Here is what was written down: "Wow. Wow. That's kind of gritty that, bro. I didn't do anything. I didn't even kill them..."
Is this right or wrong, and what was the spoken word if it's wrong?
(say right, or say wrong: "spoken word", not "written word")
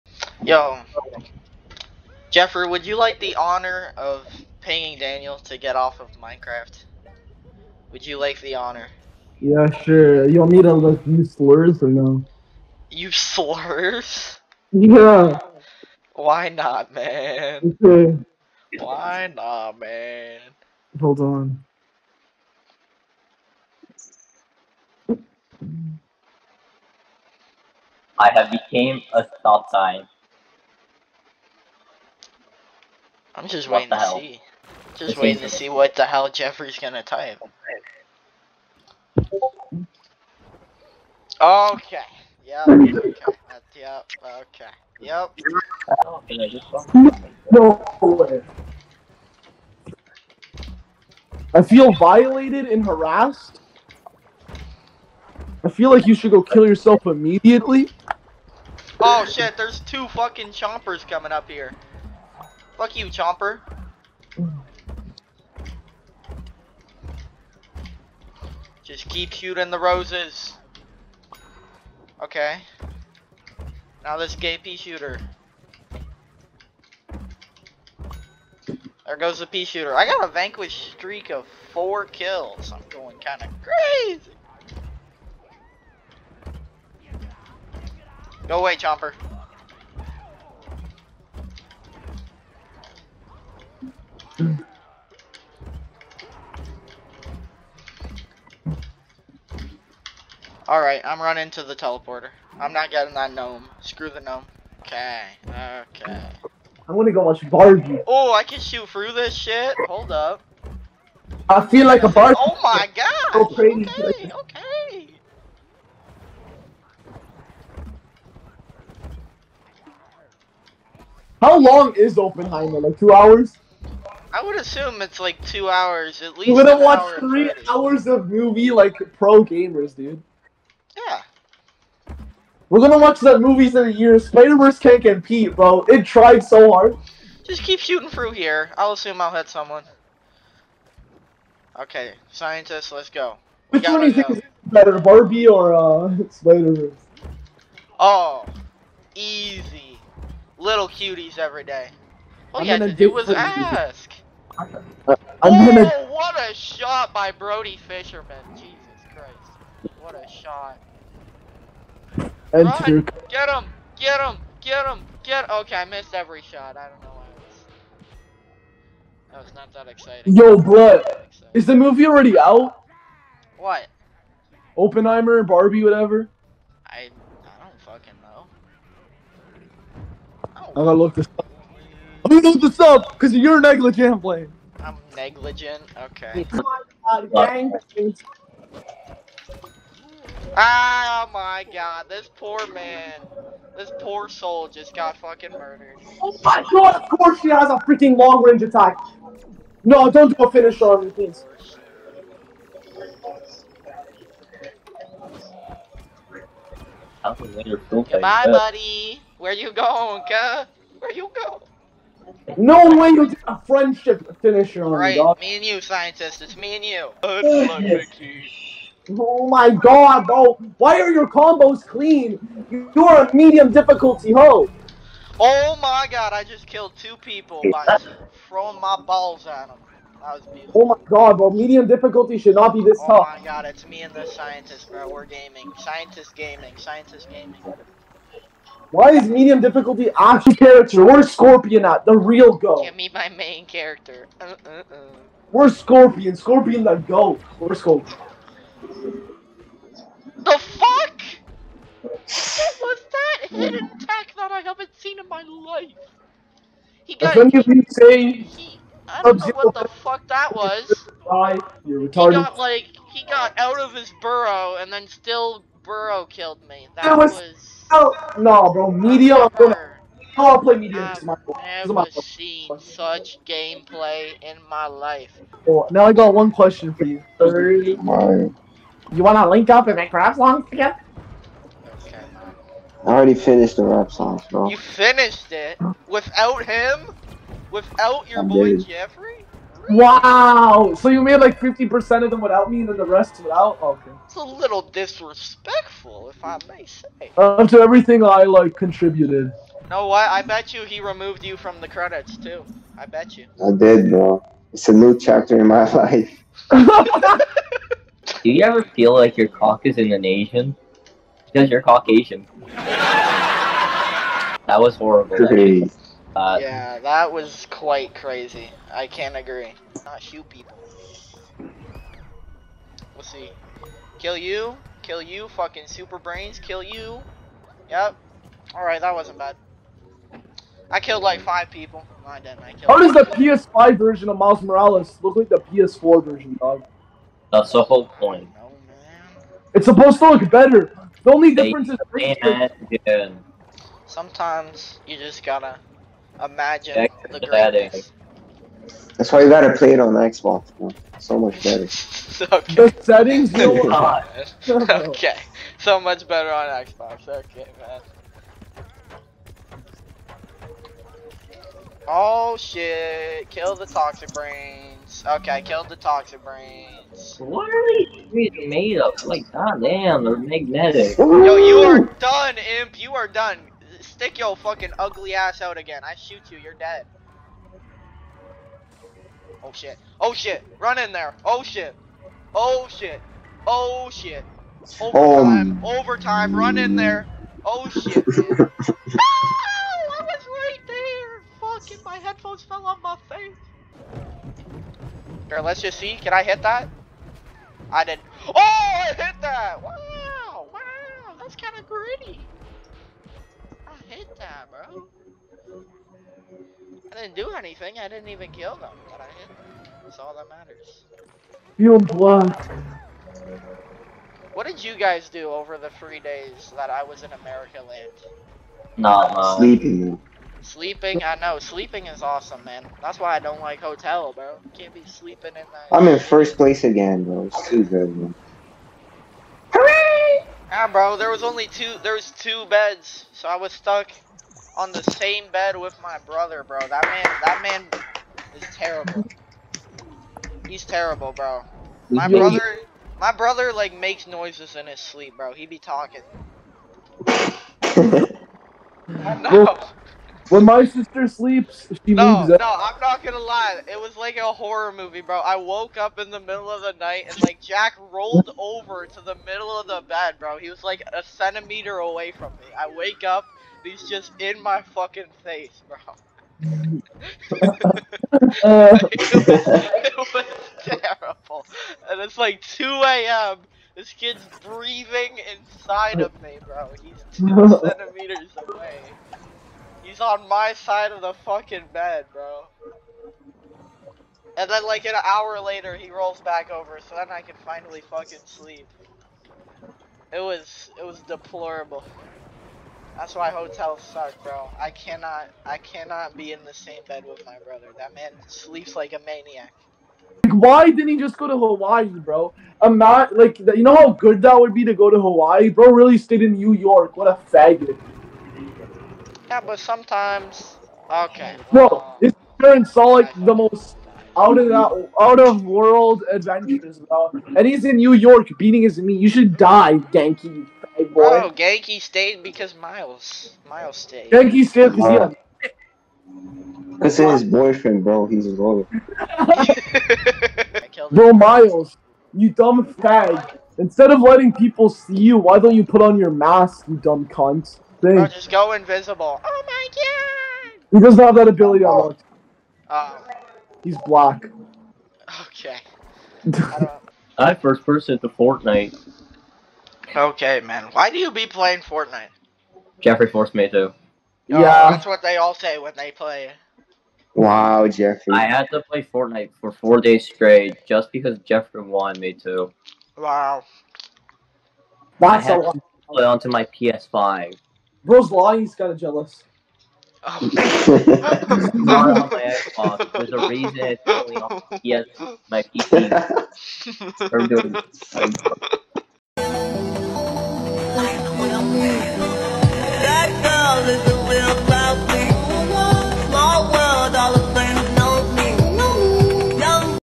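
right.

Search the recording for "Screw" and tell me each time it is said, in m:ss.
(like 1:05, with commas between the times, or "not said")
1:43.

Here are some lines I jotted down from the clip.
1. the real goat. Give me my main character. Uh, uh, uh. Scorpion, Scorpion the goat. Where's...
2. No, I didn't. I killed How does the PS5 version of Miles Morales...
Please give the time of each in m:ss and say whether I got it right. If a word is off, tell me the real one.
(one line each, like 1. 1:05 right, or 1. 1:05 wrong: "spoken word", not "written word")
1. 4:02 right
2. 5:32 right.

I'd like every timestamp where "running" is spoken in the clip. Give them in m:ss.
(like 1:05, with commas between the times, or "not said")
1:41.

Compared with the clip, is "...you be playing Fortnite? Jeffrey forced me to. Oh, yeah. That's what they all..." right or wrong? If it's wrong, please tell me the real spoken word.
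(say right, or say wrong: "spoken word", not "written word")
right.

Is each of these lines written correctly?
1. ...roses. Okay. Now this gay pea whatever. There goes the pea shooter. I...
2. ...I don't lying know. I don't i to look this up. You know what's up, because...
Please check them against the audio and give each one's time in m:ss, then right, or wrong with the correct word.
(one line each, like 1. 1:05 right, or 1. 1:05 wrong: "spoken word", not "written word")
1. 1:09 wrong: "shooter", not "whatever"
2. 2:57 wrong: "fucking", not "lying".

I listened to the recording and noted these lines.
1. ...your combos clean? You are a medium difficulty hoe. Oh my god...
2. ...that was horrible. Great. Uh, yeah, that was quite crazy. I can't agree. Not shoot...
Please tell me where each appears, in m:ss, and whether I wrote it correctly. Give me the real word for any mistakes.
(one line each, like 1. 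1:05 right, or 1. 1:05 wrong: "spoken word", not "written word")
1. 3:41 right
2. 5:12 right.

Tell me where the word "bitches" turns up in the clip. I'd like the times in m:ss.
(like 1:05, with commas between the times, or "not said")
not said.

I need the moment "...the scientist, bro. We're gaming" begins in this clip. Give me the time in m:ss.
3:54.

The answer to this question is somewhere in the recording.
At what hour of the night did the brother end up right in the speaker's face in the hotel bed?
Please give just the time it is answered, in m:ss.
7:52.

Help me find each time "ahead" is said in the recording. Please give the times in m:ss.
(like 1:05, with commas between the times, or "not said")
not said.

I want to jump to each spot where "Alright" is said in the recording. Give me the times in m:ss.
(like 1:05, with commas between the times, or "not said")
1:40, 5:28.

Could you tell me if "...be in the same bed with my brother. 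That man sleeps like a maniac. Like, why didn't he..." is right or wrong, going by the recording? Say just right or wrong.
right.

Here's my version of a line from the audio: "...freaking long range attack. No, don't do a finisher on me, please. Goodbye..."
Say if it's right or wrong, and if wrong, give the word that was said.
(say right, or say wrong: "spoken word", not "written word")
right.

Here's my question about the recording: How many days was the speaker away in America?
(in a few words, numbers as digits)
3.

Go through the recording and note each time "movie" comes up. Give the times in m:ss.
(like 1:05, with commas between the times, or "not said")
2:08, 2:13, 2:51, 7:34.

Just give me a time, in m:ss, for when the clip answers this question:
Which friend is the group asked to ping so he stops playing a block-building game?
0:04.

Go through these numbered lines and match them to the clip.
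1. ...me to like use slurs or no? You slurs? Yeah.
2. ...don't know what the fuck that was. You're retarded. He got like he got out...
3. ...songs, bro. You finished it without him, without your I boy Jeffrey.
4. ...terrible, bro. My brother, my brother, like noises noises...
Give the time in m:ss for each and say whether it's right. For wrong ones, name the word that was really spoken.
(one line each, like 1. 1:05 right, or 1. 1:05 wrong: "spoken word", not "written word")
1. 0:10 right
2. 4:19 right
3. 4:44 right
4. 7:20 wrong: "makes", not "noises".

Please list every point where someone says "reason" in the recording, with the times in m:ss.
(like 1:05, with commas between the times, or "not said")
9:33.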